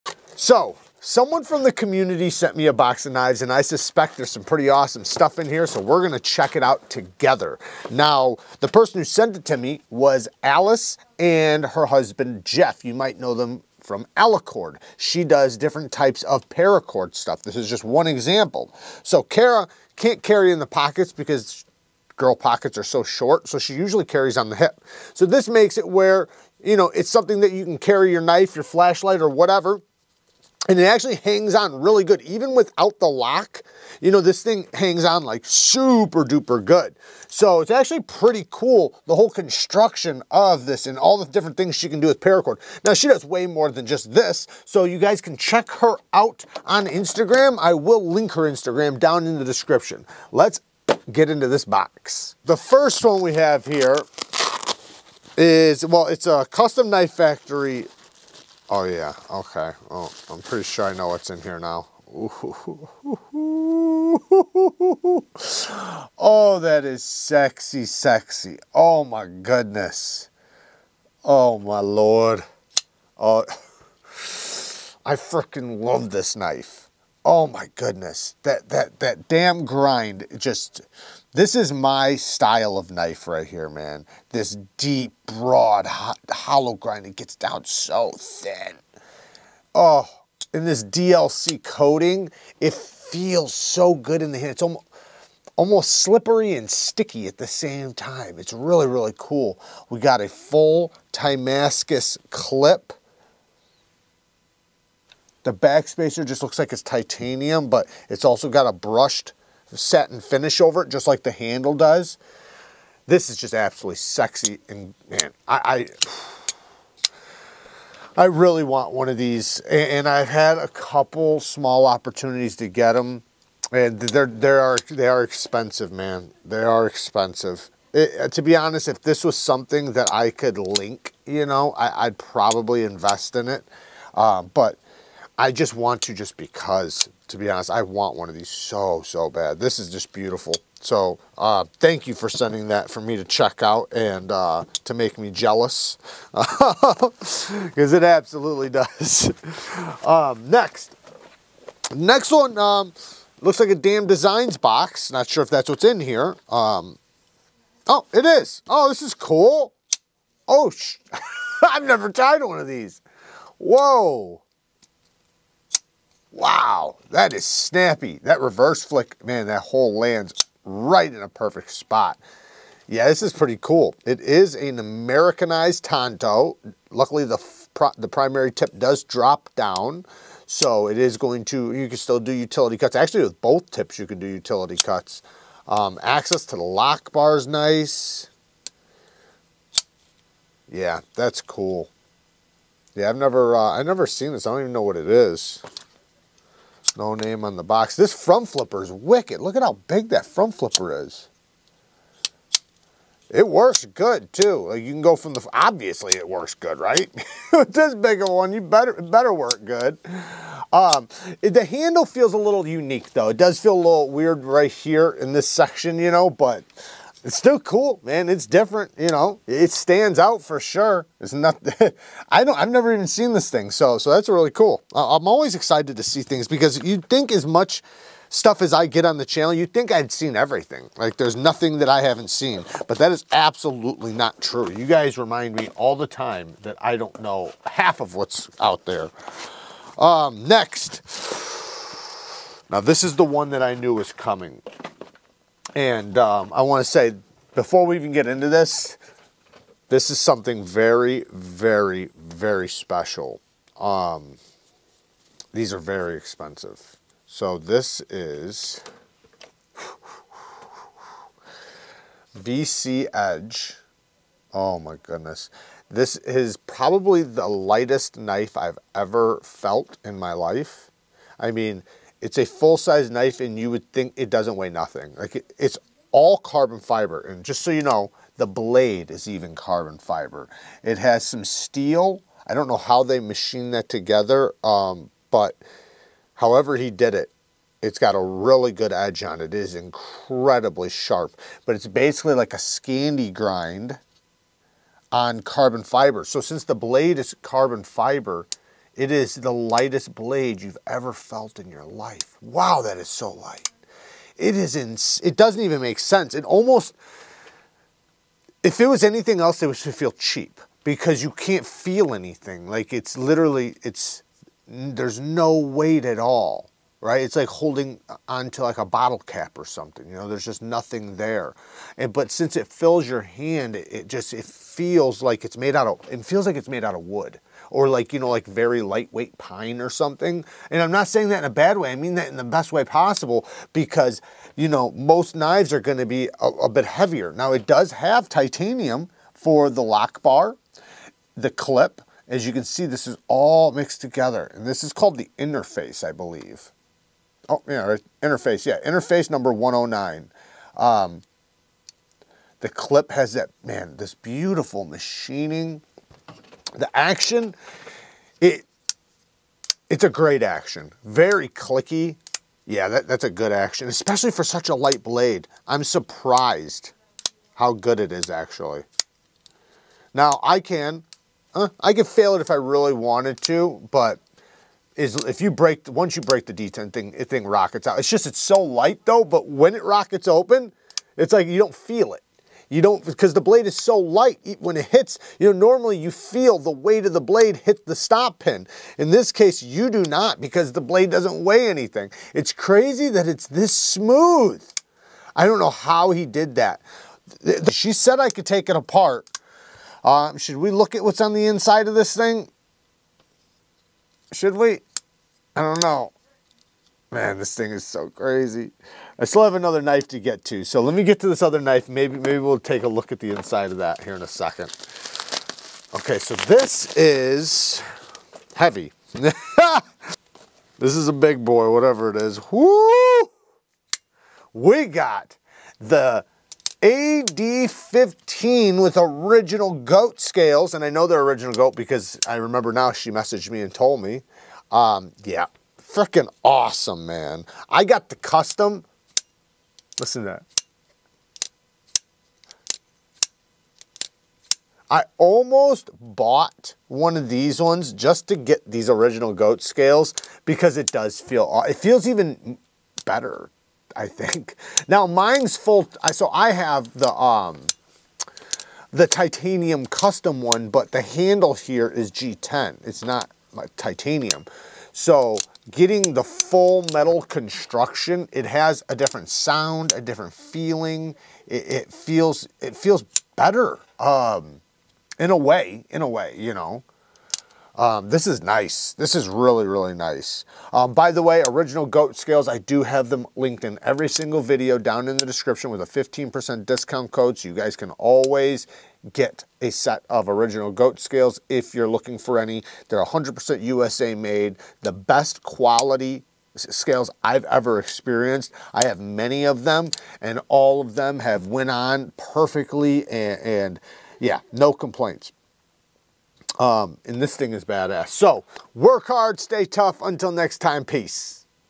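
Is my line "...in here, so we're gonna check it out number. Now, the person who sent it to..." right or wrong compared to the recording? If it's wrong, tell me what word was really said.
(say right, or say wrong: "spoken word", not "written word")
wrong: "together", not "number".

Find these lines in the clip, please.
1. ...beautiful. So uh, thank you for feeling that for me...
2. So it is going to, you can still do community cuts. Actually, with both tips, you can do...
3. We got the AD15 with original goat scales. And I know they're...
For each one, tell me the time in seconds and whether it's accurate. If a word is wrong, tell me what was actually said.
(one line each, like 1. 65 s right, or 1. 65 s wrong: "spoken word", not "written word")
1. 140 s wrong: "sending", not "feeling"
2. 180 s wrong: "utility", not "community"
3. 424 s right.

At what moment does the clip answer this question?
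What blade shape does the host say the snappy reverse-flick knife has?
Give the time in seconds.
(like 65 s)
174 s.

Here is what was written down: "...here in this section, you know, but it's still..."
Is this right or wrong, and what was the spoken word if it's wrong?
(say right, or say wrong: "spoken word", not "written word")
right.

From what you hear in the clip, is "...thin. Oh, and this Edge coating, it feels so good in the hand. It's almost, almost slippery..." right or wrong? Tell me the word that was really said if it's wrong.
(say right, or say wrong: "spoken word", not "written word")
wrong: "DLC", not "Edge".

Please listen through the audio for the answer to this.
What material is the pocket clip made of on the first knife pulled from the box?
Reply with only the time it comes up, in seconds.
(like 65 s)
101 s.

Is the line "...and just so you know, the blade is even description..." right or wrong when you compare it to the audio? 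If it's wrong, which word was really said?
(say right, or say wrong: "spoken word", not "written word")
wrong: "carbon", not "description".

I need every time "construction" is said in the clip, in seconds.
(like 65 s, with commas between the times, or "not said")
39 s, 467 s.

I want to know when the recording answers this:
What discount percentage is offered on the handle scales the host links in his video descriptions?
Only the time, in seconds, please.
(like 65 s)
485 s.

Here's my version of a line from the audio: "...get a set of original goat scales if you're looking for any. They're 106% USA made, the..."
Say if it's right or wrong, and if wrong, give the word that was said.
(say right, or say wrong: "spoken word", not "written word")
wrong: "100", not "106".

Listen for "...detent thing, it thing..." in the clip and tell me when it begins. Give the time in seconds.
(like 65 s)
376 s.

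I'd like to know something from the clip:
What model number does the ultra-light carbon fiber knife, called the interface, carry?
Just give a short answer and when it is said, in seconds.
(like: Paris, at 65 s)
109, at 348 s.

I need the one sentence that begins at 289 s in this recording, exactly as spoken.
It is incredibly sharp, but it's basically like a Scandi grind on carbon fiber.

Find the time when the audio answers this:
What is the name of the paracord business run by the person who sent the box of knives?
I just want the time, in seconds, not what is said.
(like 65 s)
14 s.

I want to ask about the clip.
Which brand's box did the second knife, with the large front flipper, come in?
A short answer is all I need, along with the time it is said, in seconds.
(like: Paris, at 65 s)
Damned Designs, at 153 s.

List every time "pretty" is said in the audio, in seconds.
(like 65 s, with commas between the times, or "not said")
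4 s, 38 s, 60 s, 173 s.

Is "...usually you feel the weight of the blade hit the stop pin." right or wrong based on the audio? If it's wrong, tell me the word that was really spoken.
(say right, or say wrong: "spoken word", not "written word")
wrong: "normally", not "usually".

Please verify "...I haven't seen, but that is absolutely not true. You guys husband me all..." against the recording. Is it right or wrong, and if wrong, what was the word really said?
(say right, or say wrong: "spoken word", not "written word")
wrong: "remind", not "husband".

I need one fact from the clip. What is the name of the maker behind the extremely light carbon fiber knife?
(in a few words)
VC Edge.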